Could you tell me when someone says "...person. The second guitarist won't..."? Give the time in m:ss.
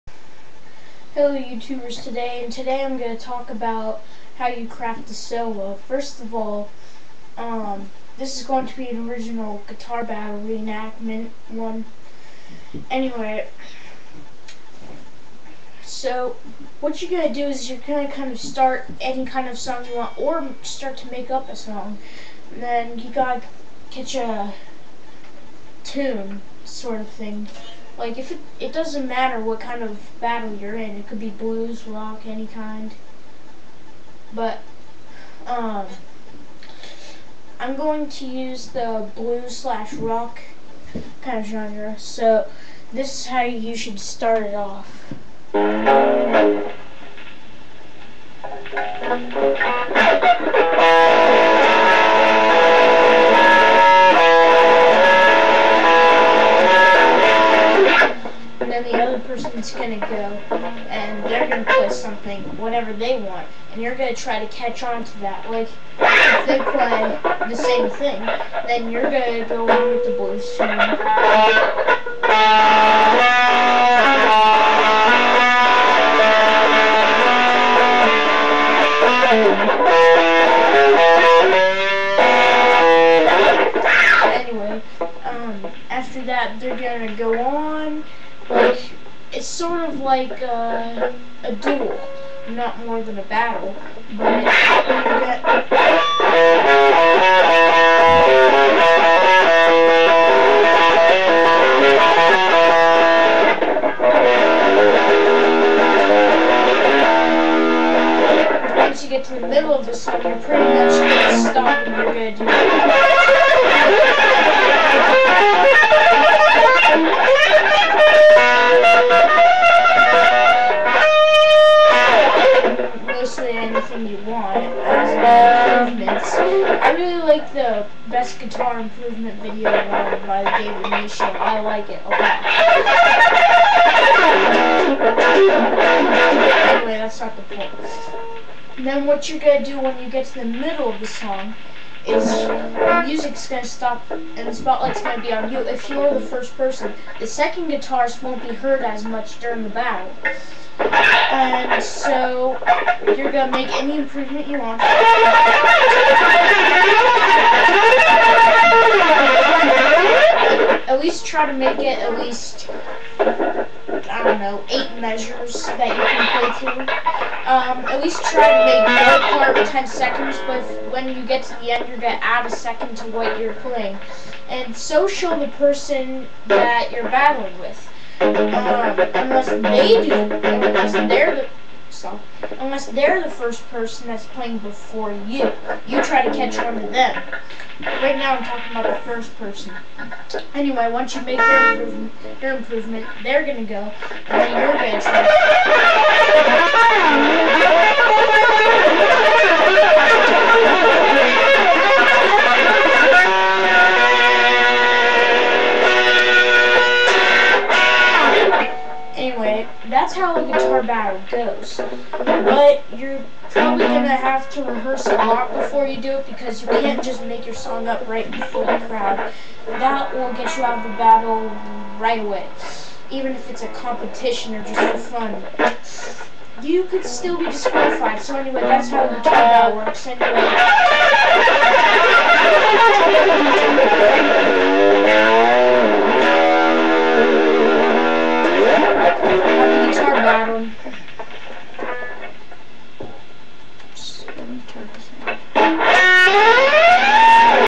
2:26.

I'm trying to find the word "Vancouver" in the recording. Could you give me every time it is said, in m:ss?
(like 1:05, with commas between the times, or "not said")
not said.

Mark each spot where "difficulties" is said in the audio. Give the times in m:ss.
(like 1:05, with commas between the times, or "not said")
not said.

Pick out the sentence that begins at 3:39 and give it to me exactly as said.
That will get you out of the battle right away, even if it's a competition or just for fun.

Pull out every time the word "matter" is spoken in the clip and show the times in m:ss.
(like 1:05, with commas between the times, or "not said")
0:29.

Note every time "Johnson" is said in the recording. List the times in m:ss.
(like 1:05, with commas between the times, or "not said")
not said.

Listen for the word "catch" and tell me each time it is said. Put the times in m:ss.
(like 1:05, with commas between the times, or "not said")
0:23, 1:04, 3:06.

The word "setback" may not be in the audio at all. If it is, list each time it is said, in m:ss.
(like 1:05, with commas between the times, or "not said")
not said.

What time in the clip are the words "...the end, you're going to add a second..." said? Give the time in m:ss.
2:51.